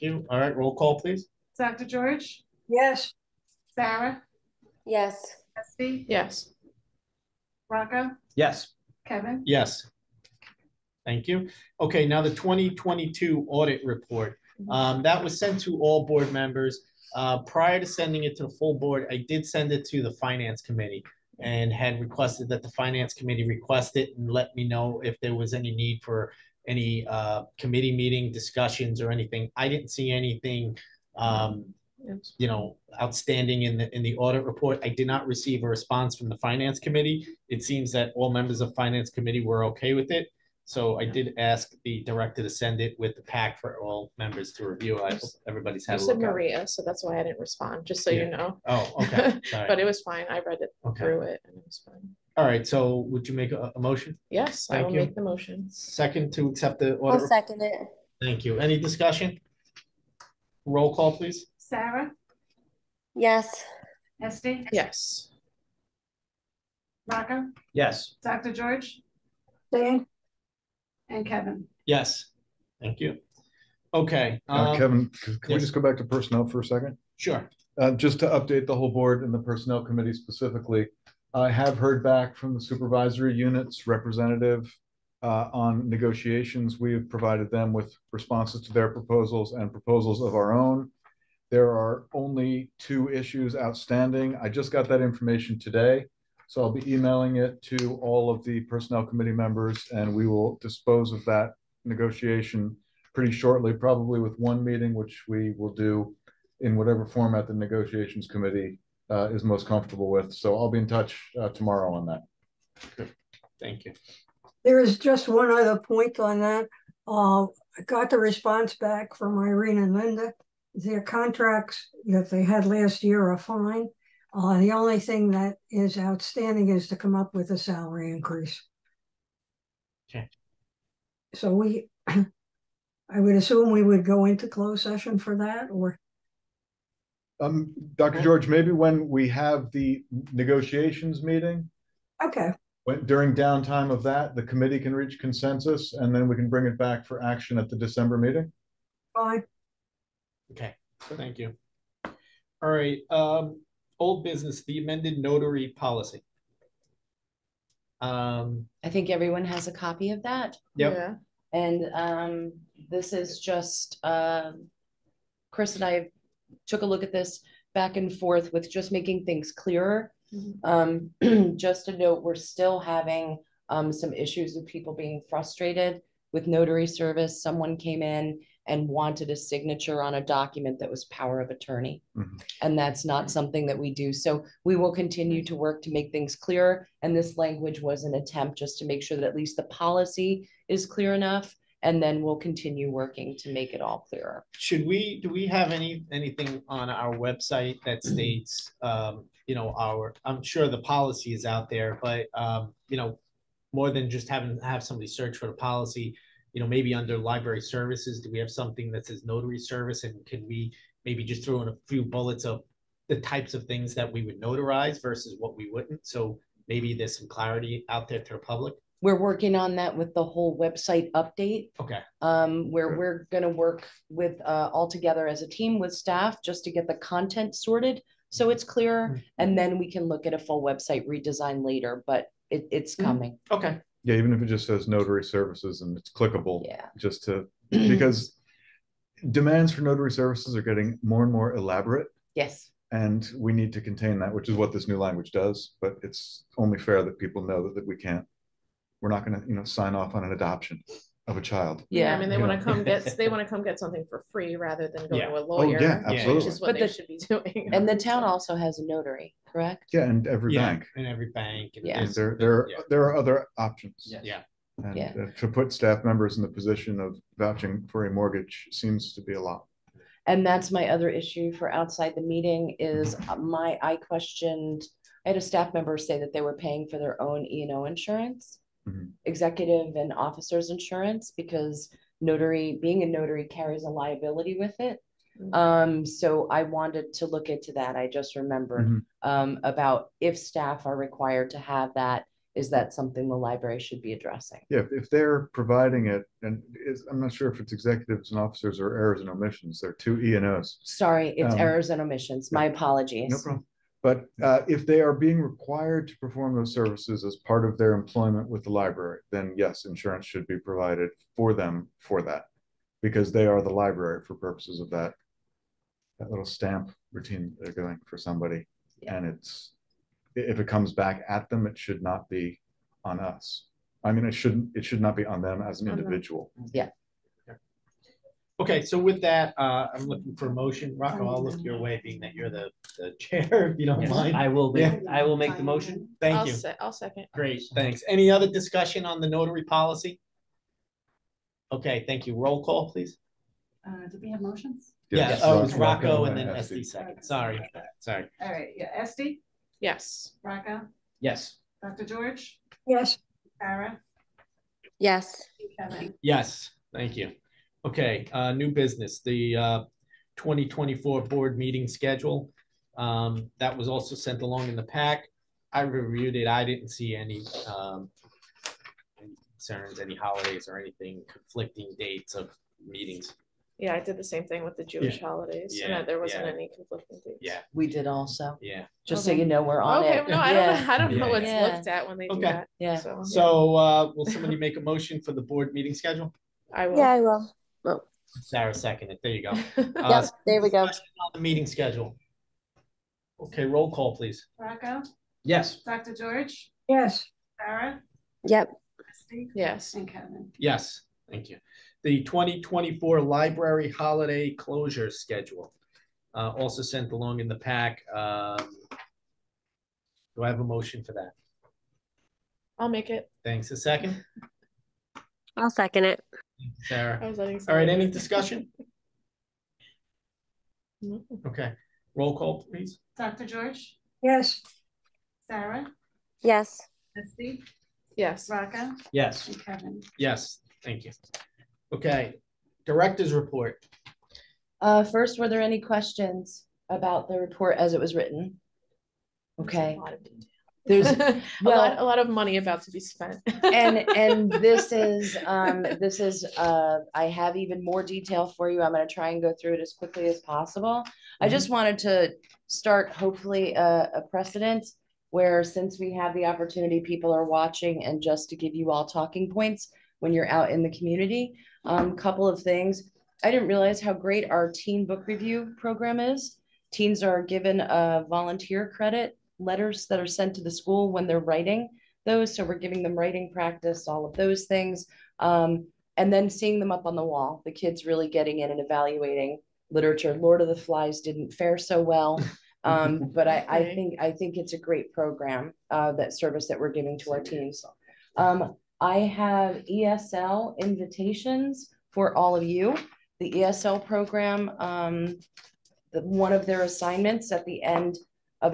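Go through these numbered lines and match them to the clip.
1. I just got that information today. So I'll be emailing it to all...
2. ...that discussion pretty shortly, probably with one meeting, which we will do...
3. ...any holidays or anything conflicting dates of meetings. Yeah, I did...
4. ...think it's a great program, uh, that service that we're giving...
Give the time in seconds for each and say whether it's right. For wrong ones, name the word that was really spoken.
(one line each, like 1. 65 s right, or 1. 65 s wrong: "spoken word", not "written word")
1. 94 s right
2. 101 s wrong: "negotiation", not "discussion"
3. 369 s right
4. 484 s right.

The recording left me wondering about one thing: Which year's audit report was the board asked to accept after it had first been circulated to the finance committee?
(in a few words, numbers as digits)
2022.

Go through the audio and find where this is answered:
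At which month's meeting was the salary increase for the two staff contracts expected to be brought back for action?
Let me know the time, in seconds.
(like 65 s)
147 s.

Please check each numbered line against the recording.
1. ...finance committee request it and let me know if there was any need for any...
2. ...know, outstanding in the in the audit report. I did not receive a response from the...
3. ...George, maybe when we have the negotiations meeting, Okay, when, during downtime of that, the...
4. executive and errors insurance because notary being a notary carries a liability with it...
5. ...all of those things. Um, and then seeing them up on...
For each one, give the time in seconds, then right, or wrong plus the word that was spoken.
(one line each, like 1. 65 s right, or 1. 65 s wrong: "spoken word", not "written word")
1. 22 s right
2. 32 s right
3. 138 s right
4. 279 s wrong: "officers", not "errors"
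5. 474 s right.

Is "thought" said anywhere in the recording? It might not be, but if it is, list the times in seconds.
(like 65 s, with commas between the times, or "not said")
not said.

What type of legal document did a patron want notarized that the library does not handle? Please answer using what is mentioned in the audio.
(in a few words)
Power of attorney.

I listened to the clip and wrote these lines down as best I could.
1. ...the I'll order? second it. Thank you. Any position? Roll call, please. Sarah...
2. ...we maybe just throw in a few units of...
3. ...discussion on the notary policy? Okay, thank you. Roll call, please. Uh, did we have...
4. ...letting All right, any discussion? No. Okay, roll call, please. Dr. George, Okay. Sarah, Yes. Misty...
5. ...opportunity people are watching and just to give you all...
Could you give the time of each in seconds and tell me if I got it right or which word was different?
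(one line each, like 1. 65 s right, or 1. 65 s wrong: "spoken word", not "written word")
1. 56 s wrong: "discussion", not "position"
2. 210 s wrong: "bullets", not "units"
3. 338 s right
4. 417 s wrong: "Yes", not "Okay"
5. 456 s right.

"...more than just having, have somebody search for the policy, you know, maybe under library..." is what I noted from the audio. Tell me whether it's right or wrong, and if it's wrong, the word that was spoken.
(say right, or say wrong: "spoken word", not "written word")
right.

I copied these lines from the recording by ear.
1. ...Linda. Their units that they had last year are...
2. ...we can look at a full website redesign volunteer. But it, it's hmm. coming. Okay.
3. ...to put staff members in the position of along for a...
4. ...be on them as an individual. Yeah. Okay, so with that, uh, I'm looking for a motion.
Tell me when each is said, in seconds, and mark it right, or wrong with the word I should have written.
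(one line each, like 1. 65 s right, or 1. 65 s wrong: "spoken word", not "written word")
1. 119 s wrong: "contracts", not "units"
2. 229 s wrong: "later", not "volunteer"
3. 265 s wrong: "vouching", not "along"
4. 325 s right.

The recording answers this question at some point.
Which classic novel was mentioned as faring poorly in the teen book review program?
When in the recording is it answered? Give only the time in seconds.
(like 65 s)
480 s.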